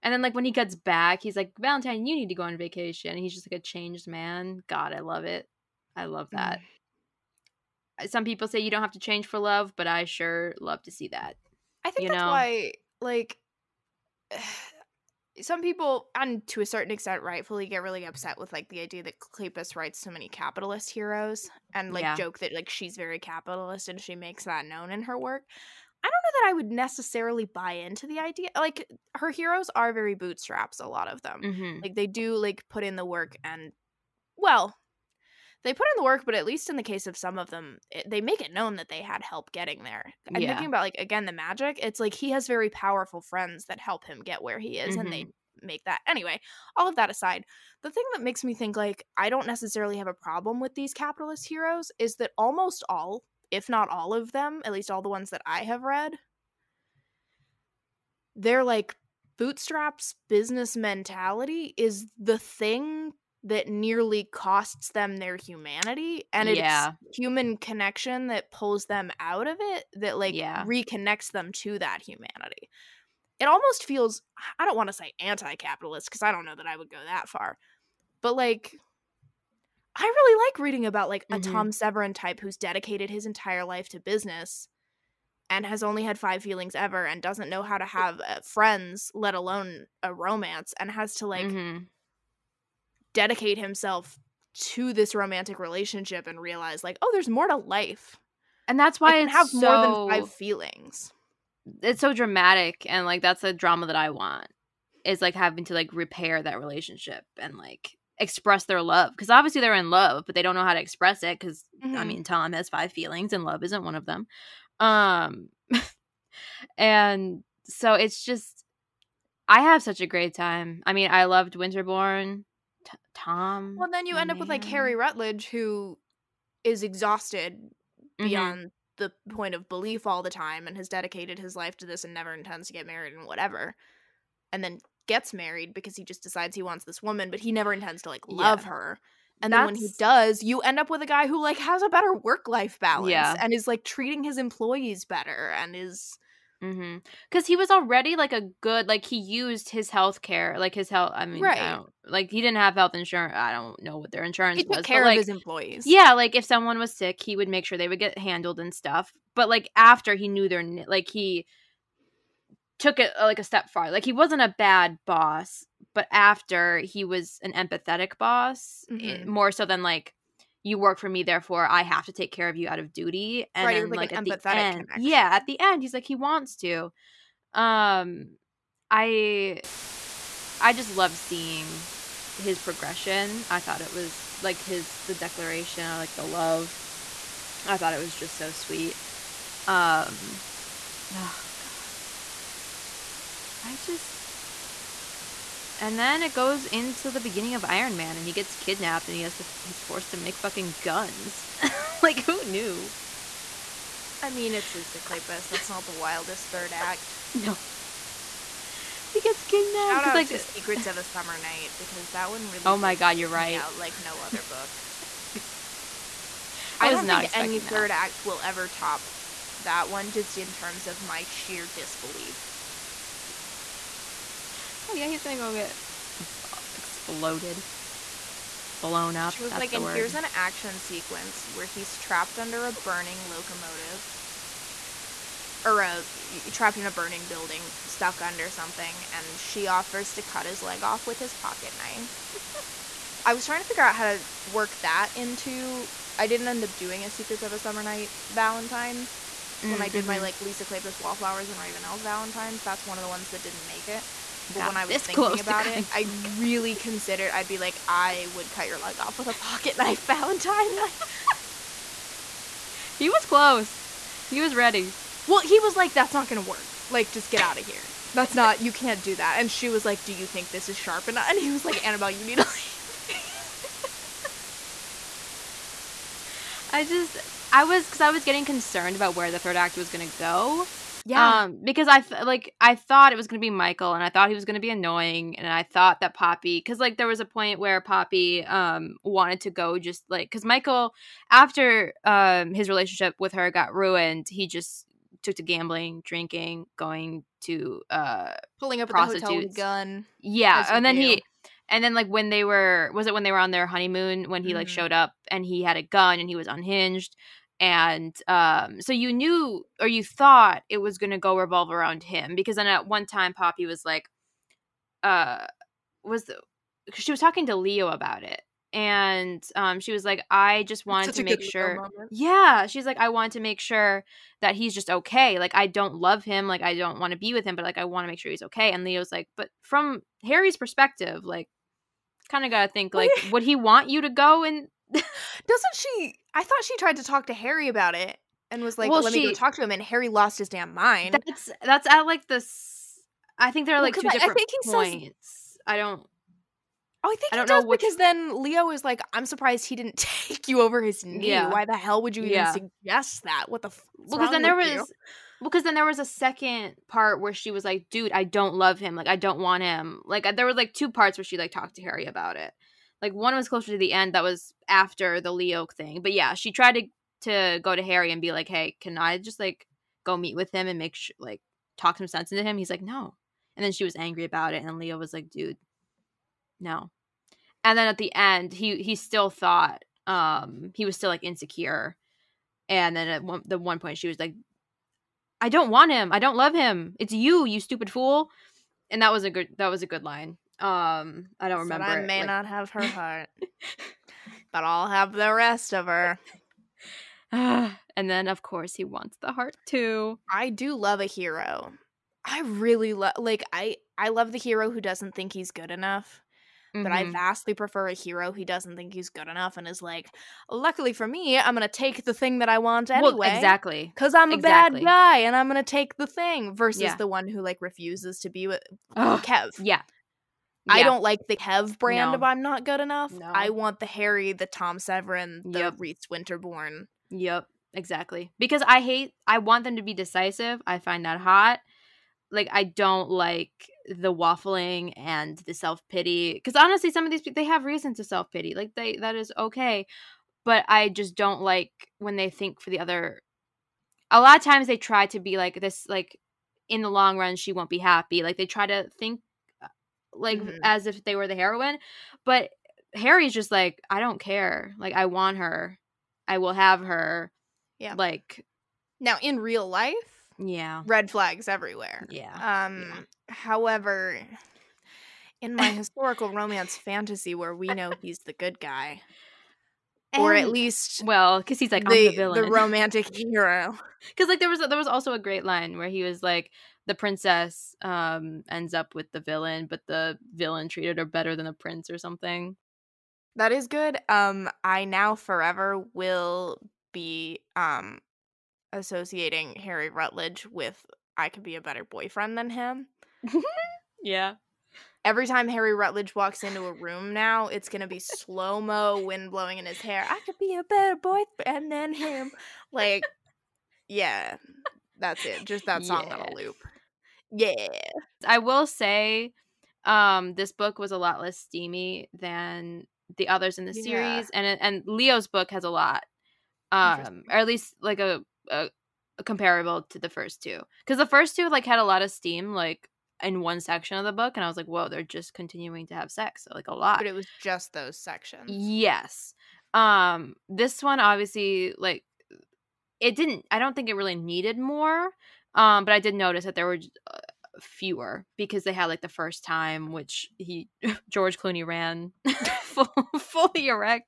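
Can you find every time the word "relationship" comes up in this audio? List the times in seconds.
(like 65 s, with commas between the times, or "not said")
95 s, 106 s, 292 s.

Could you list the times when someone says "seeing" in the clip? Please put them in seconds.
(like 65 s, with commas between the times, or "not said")
181 s.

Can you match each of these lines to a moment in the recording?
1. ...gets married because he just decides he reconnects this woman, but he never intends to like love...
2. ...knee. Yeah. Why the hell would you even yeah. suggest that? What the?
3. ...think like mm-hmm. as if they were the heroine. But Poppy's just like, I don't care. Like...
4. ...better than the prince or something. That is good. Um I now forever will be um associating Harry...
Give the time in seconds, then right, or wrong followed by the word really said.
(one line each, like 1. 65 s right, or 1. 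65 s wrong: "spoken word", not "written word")
1. 135 s wrong: "wants", not "reconnects"
2. 351 s right
3. 448 s wrong: "Harry", not "Poppy"
4. 481 s right.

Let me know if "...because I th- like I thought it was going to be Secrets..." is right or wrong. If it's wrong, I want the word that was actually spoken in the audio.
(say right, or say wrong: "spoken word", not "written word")
wrong: "Michael", not "Secrets".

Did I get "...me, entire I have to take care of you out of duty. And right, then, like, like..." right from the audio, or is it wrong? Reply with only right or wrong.
wrong.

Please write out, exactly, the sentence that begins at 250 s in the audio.
like Lisa Kleypas Wallflowers and Ravenels Valentines, that's one of the ones that didn't make it.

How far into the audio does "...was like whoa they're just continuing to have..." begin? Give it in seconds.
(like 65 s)
524 s.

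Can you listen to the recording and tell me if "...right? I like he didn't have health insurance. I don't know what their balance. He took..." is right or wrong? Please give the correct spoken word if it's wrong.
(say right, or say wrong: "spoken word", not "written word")
wrong: "insurance", not "balance".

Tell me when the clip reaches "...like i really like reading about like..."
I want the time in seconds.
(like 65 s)
78 s.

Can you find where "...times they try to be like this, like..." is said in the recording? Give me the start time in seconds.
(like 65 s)
444 s.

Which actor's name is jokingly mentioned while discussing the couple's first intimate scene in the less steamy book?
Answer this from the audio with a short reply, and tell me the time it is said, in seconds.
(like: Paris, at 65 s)
George Clooney, at 541 s.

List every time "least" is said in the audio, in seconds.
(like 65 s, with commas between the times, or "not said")
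36 s, 54 s, 470 s, 517 s.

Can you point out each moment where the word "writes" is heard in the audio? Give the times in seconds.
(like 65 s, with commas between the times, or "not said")
19 s.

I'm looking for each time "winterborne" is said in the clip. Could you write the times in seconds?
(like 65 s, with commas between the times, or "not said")
121 s, 426 s.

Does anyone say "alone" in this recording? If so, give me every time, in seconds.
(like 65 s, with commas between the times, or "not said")
89 s.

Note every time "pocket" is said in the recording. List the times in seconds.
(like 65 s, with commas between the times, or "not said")
241 s, 259 s.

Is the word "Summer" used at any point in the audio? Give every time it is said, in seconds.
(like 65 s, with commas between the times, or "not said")
211 s, 247 s.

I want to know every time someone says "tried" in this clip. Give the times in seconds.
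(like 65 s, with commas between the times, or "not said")
336 s, 366 s.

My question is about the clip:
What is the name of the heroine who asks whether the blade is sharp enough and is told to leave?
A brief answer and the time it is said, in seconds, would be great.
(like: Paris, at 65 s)
Annabelle, at 271 s.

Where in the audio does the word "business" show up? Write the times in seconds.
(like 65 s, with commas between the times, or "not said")
60 s, 83 s.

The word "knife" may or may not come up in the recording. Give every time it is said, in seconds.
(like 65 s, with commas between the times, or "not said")
241 s, 259 s.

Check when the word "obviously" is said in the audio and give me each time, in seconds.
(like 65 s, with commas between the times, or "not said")
109 s, 531 s.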